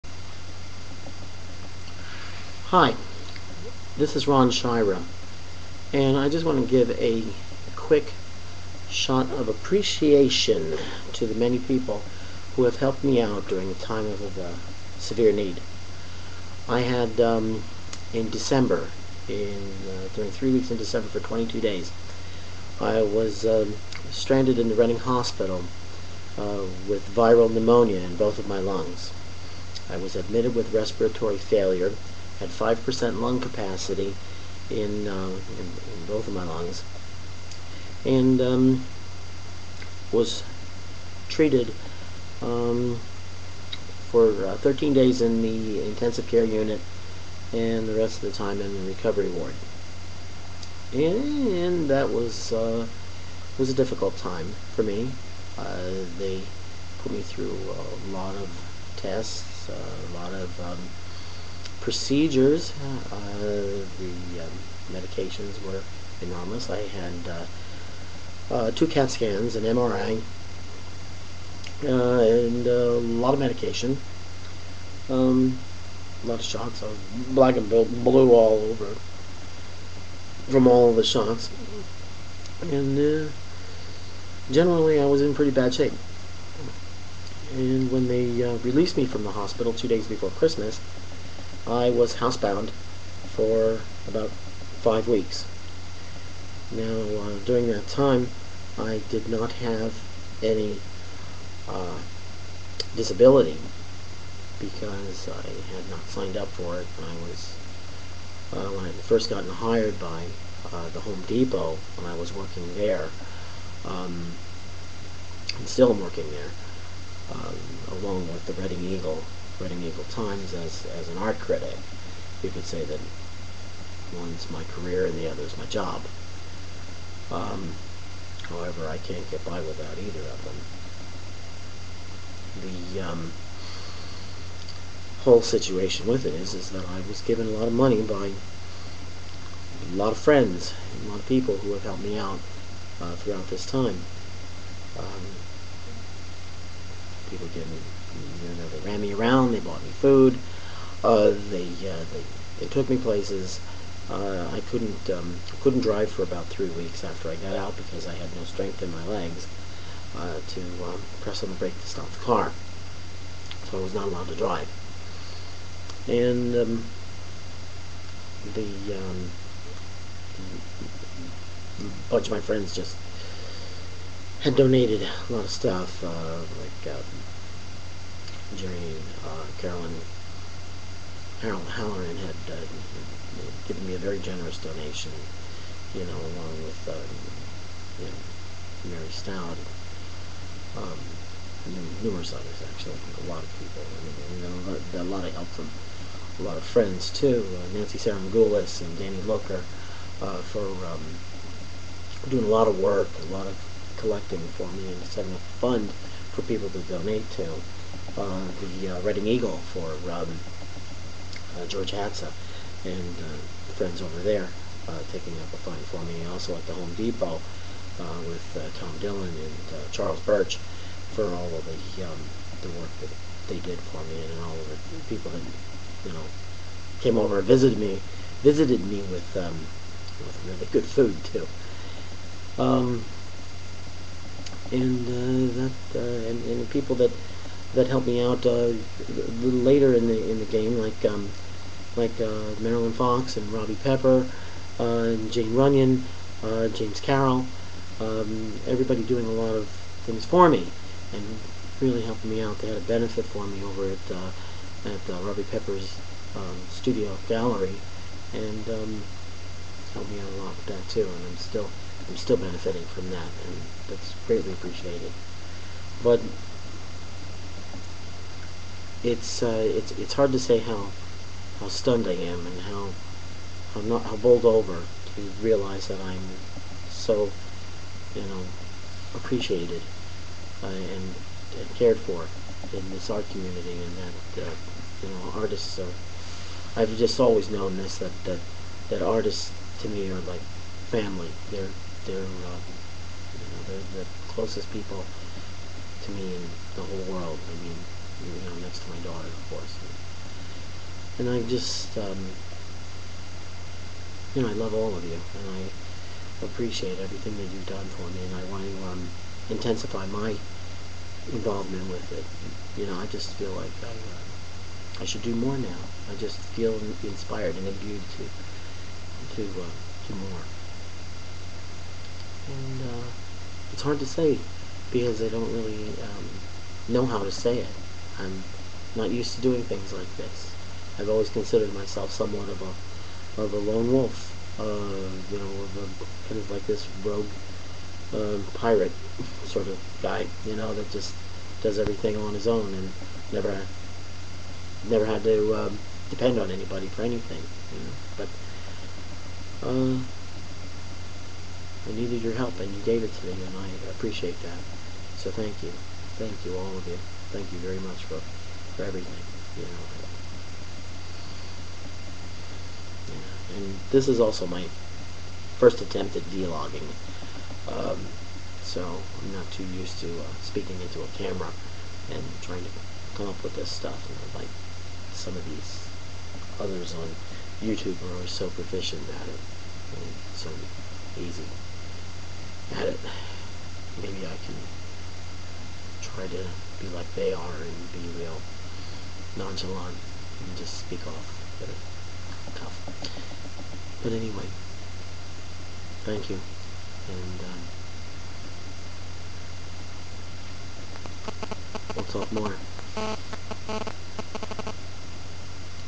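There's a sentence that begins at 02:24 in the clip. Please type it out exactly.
Um, people give me you know, they ran me around.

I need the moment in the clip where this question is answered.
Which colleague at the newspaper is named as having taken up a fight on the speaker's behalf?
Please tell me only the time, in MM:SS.
03:31.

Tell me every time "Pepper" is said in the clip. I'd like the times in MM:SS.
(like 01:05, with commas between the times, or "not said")
04:03, 04:15.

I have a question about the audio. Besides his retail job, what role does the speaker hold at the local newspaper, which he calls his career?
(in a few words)
art critic.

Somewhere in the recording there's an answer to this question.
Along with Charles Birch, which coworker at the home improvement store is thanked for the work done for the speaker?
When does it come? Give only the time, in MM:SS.
03:38.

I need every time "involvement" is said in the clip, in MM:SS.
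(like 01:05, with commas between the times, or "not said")
05:11.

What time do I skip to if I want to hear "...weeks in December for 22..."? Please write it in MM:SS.
00:20.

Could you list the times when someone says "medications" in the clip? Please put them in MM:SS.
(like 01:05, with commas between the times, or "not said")
01:04, 01:13.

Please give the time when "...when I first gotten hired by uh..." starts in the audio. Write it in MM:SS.
01:48.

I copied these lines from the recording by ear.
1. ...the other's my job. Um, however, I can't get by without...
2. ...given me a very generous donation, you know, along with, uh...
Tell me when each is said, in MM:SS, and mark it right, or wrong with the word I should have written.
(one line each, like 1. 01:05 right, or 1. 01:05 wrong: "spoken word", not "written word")
1. 02:05 right
2. 03:03 right.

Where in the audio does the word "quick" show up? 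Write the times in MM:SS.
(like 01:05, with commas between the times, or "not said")
00:07.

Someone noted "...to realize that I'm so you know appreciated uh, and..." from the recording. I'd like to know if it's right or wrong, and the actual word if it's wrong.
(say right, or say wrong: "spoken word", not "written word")
right.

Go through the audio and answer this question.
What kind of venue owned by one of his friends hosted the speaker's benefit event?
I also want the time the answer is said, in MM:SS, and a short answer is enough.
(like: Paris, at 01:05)
studio gallery, at 04:16.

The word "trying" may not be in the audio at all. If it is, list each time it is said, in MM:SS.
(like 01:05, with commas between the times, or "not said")
06:12.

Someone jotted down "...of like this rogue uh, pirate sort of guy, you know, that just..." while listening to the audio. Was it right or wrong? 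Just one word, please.
right.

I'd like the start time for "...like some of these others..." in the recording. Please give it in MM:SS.
06:14.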